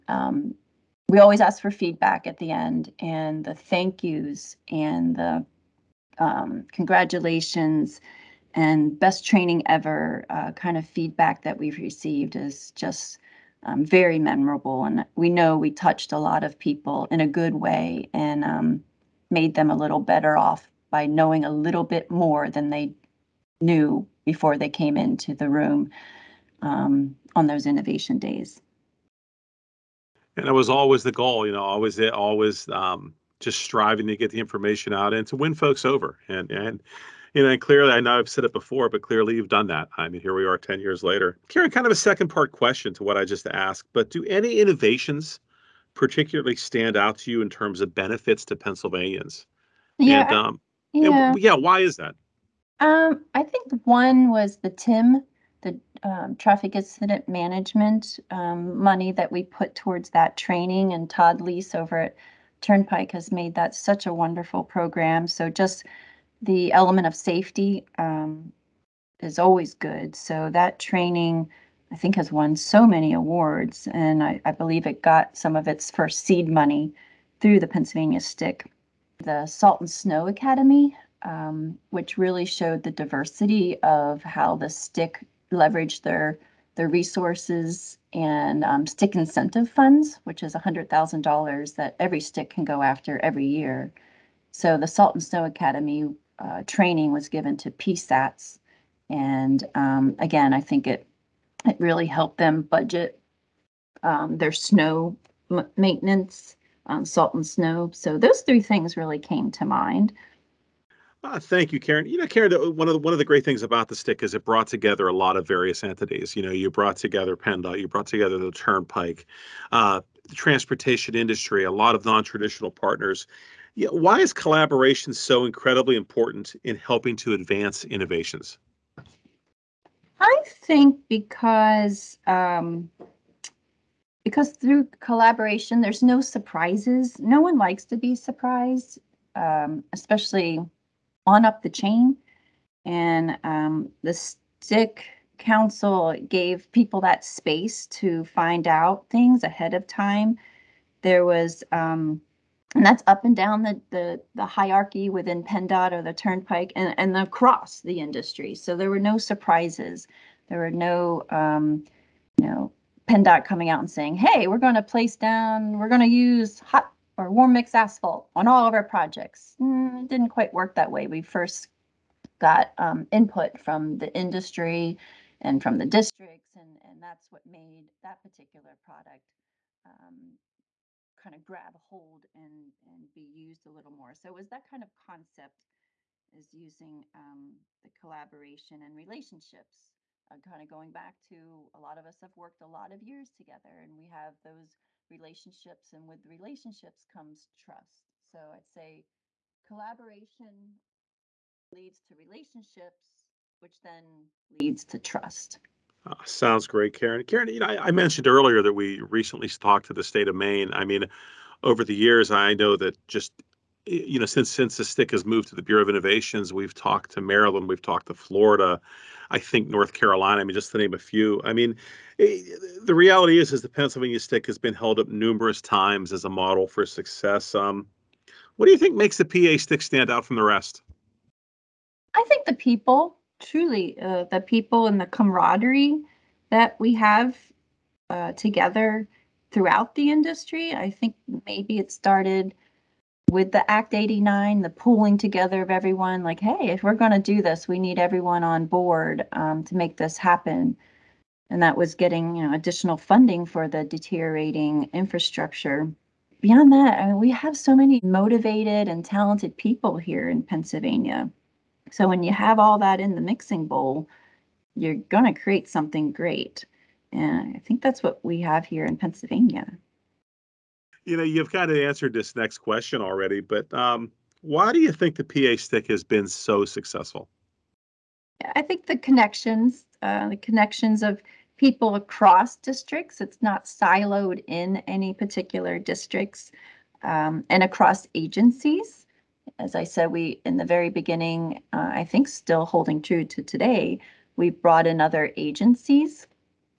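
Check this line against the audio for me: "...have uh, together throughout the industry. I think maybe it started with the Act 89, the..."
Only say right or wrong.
right.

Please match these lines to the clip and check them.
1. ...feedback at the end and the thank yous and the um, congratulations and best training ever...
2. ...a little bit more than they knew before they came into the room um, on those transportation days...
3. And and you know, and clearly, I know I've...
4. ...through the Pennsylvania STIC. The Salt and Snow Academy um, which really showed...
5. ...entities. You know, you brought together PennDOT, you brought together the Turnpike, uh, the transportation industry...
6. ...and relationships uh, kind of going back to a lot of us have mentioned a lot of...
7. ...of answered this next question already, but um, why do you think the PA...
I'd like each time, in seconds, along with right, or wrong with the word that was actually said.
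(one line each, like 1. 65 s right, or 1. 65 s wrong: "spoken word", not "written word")
1. 1 s right
2. 21 s wrong: "innovation", not "transportation"
3. 36 s right
4. 77 s right
5. 115 s right
6. 188 s wrong: "worked", not "mentioned"
7. 271 s right.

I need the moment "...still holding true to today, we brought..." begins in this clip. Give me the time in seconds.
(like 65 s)
292 s.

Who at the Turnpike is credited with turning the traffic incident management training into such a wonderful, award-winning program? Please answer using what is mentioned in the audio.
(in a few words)
Todd Lease.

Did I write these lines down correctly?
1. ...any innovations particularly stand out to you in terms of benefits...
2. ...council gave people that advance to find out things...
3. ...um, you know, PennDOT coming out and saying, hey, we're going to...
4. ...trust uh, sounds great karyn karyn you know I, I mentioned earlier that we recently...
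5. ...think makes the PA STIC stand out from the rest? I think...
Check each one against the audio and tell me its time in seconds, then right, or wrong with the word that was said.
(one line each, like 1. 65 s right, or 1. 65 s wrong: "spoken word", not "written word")
1. 44 s right
2. 145 s wrong: "space", not "advance"
3. 161 s right
4. 204 s right
5. 228 s right.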